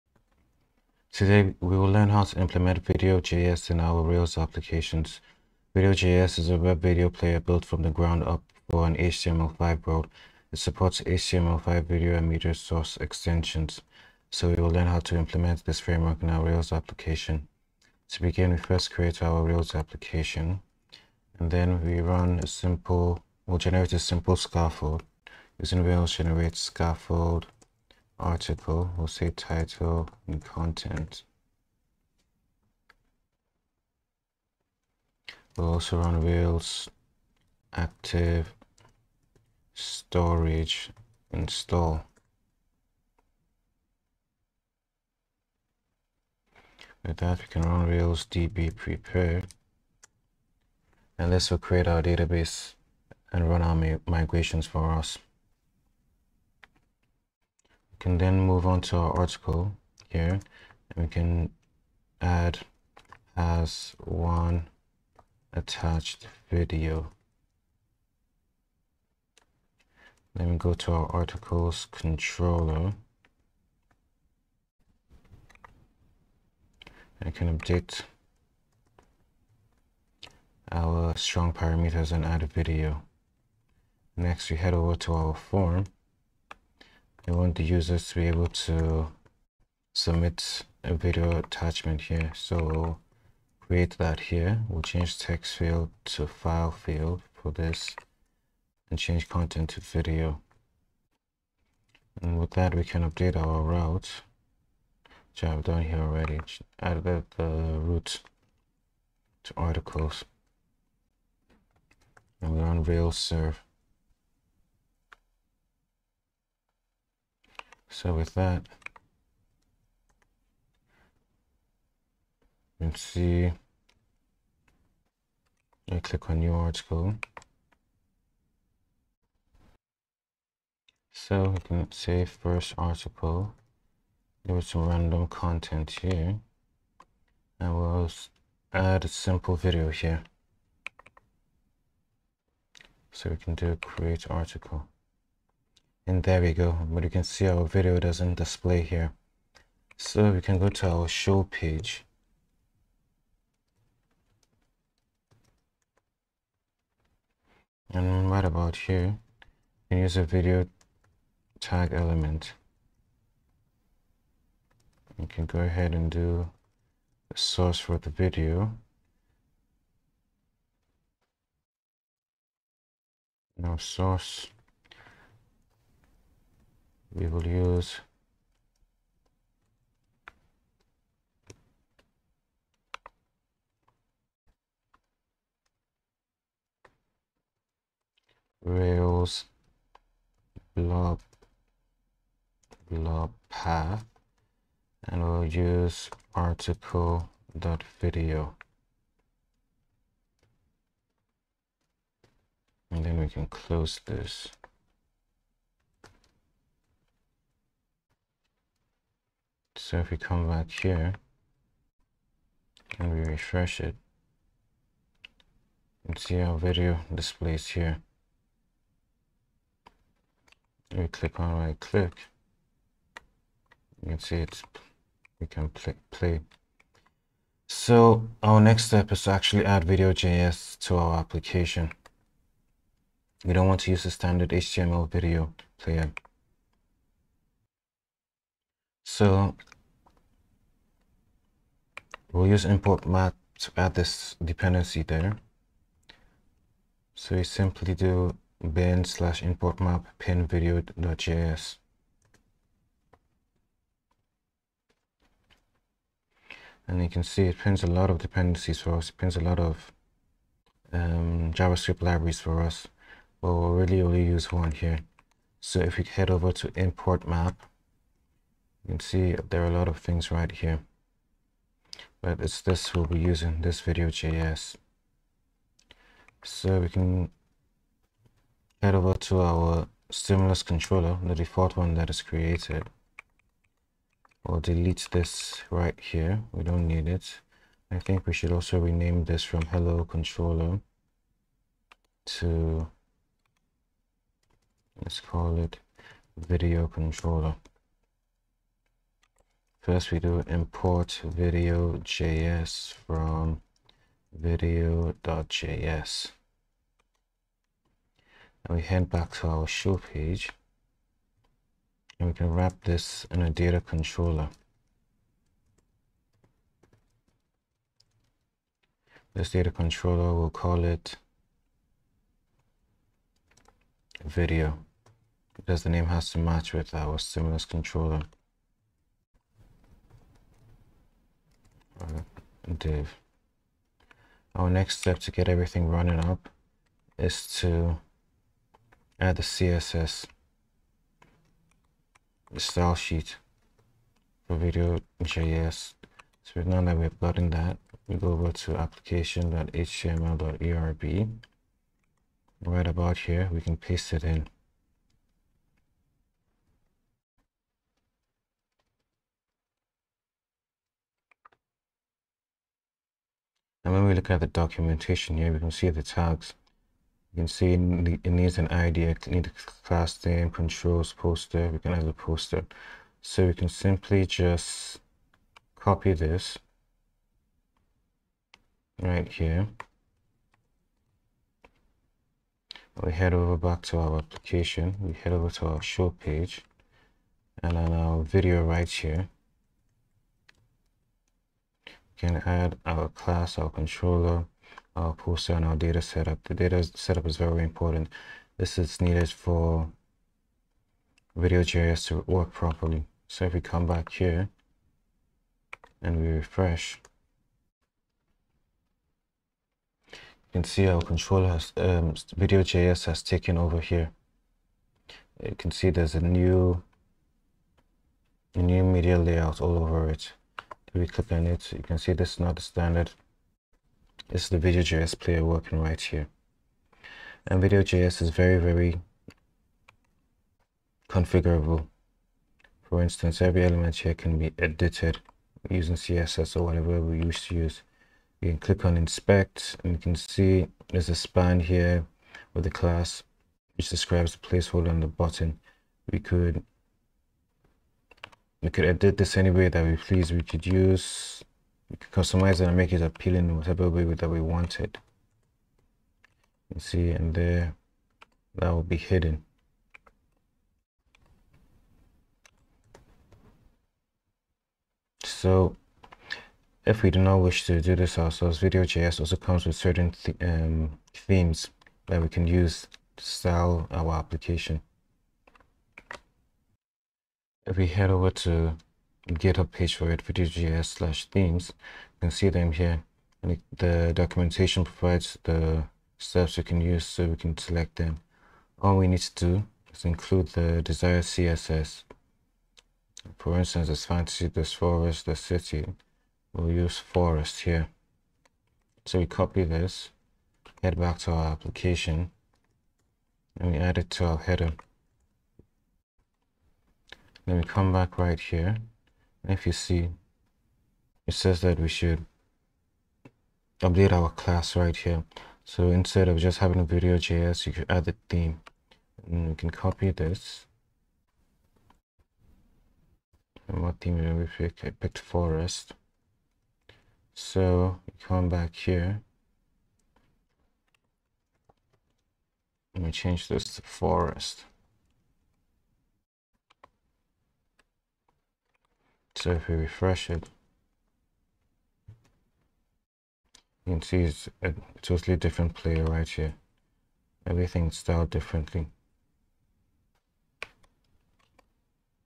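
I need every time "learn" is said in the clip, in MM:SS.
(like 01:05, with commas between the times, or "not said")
00:01, 00:14.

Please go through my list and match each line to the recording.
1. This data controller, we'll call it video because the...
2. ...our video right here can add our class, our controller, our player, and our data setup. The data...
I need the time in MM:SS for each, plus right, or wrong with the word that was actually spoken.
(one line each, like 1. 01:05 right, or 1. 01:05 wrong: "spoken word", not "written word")
1. 05:19 right
2. 06:27 wrong: "poster", not "player".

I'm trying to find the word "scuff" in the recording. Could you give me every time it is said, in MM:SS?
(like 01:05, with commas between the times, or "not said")
not said.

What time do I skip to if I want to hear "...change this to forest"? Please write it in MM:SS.
08:53.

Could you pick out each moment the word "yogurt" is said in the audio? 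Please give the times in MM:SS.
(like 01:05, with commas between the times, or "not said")
not said.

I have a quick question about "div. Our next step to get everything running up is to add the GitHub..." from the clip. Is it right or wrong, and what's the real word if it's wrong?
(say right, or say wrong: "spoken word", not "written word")
wrong: "CSS", not "GitHub".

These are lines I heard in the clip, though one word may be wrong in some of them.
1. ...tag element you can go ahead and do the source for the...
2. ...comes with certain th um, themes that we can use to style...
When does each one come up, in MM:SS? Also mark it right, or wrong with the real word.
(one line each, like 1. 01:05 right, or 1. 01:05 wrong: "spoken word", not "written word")
1. 02:41 right
2. 07:49 right.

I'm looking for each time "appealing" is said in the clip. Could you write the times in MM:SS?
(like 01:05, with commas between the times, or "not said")
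07:33.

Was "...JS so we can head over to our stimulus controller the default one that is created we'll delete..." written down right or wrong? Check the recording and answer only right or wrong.
right.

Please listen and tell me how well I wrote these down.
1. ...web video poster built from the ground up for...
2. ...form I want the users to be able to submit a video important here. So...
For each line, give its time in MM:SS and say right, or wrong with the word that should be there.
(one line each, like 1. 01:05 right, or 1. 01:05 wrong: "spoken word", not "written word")
1. 00:06 wrong: "player", not "poster"
2. 01:25 wrong: "attachment", not "important".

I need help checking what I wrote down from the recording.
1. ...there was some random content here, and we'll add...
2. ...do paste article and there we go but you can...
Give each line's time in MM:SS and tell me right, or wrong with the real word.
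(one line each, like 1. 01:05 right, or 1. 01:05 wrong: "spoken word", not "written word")
1. 02:14 right
2. 02:23 wrong: "create", not "paste".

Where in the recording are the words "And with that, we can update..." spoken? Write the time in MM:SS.
01:42.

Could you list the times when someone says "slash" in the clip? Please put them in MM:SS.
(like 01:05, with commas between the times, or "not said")
04:09, 08:00.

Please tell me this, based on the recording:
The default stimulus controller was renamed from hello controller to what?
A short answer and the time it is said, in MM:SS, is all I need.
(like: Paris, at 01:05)
video controller, at 04:56.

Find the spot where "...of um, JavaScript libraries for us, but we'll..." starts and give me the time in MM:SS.
04:19.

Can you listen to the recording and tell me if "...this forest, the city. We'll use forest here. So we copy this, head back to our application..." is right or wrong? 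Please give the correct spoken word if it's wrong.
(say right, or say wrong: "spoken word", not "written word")
right.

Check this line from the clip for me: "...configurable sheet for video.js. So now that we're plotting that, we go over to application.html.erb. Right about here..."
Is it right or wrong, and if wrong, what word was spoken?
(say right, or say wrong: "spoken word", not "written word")
wrong: "style", not "configurable".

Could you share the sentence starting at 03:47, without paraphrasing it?
So our next step is to actually add Video.js to our application.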